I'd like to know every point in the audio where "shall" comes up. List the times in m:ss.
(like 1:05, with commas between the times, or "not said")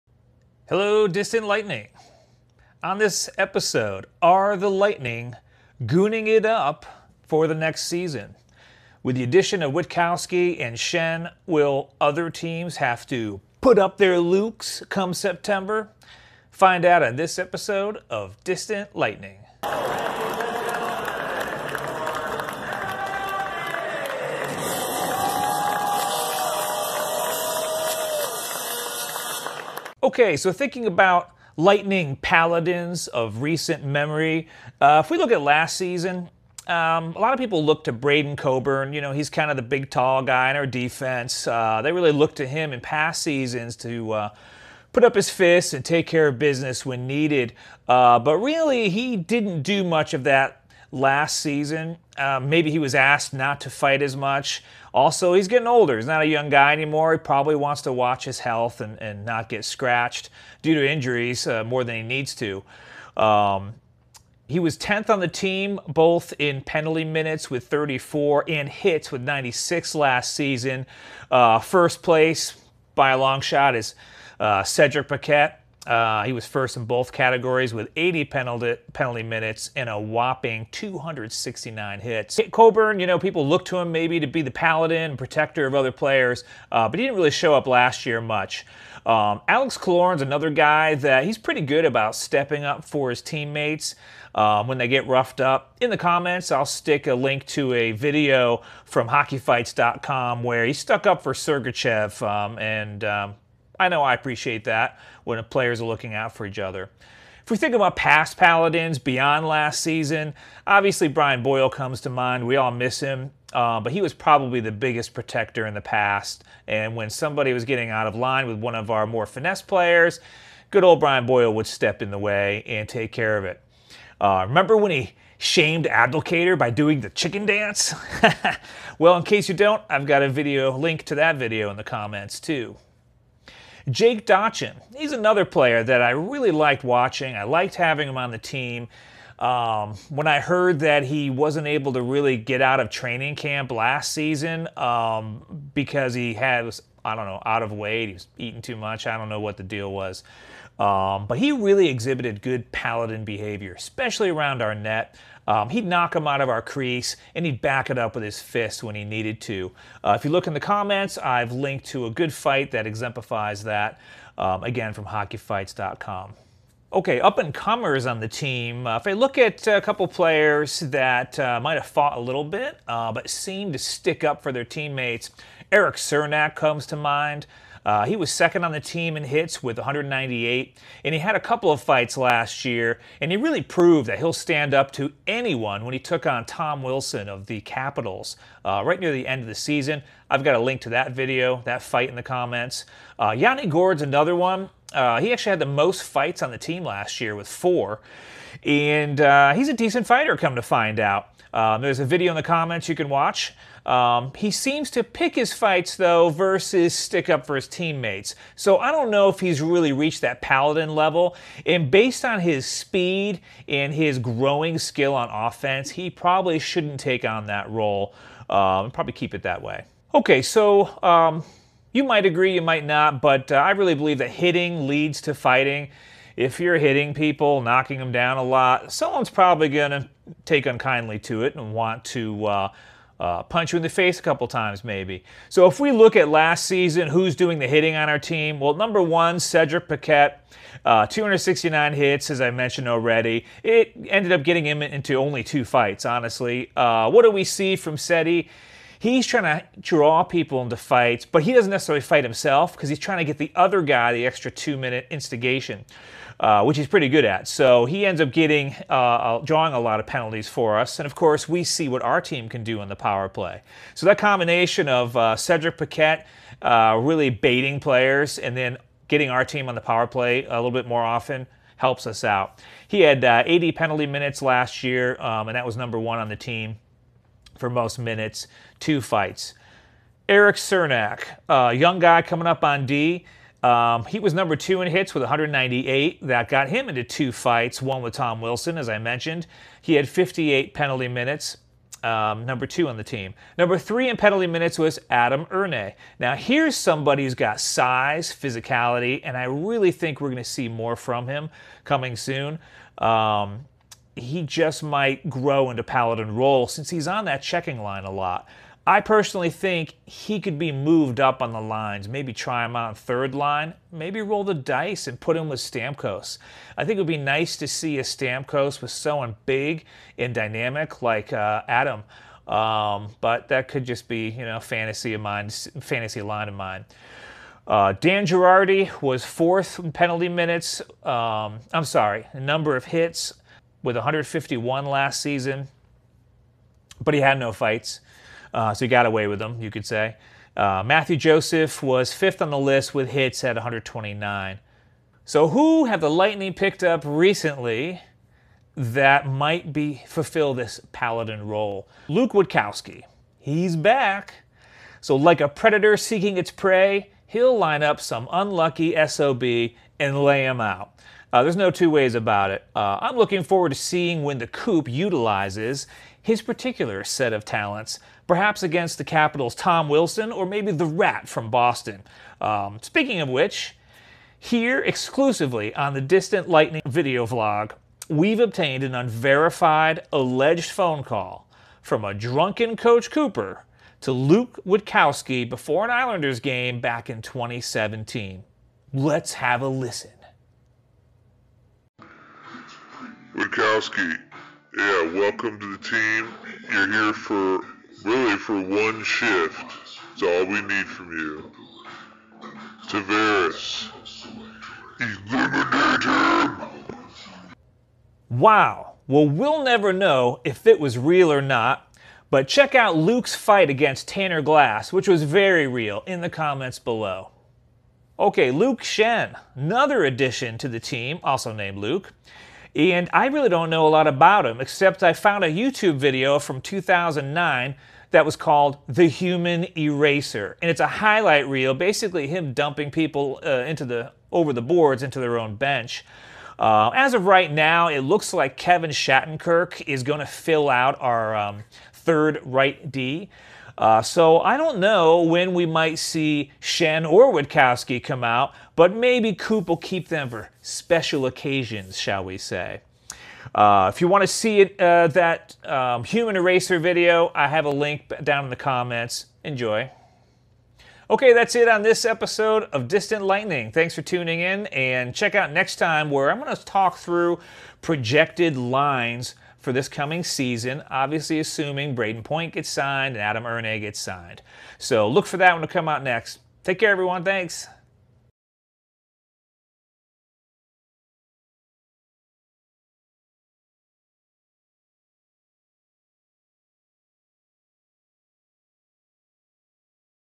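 7:31.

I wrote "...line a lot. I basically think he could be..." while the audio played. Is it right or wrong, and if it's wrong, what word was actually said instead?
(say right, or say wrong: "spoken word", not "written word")
wrong: "personally", not "basically".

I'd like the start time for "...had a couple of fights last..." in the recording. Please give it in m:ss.
3:01.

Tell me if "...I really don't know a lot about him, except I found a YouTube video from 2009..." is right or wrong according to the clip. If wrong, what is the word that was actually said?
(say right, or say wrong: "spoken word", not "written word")
right.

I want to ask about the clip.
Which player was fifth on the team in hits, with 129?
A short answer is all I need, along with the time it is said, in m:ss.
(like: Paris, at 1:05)
Mathieu Joseph, at 5:40.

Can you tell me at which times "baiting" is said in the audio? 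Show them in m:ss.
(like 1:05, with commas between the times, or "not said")
4:27.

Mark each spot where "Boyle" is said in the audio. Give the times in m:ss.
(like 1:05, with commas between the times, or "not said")
1:51, 2:01.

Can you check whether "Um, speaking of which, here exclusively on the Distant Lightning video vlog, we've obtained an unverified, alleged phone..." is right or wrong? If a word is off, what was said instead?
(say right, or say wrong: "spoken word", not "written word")
right.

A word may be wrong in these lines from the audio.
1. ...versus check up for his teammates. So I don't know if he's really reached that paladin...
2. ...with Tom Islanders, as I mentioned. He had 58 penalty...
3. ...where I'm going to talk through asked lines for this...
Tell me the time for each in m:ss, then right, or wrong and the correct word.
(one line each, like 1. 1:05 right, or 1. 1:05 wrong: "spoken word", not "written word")
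1. 3:26 wrong: "stick", not "check"
2. 4:48 wrong: "Wilson", not "Islanders"
3. 7:46 wrong: "projected", not "asked".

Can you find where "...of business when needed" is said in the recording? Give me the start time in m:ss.
0:46.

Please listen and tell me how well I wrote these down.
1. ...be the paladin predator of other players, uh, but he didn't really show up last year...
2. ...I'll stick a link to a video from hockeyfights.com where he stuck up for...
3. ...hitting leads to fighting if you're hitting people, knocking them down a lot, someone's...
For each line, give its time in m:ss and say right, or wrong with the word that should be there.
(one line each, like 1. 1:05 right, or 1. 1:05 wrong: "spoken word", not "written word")
1. 1:24 wrong: "protector", not "predator"
2. 1:36 right
3. 3:44 right.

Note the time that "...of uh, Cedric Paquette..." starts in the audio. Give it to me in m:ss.
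4:24.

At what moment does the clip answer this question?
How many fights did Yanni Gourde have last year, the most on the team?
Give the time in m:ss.
3:17.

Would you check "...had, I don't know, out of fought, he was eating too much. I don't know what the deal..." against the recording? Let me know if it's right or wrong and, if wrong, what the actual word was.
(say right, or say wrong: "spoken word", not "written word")
wrong: "weight", not "fought".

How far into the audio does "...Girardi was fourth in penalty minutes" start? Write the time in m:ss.
5:28.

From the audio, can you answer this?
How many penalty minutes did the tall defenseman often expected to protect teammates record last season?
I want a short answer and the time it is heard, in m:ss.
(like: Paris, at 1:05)
34, at 1:07.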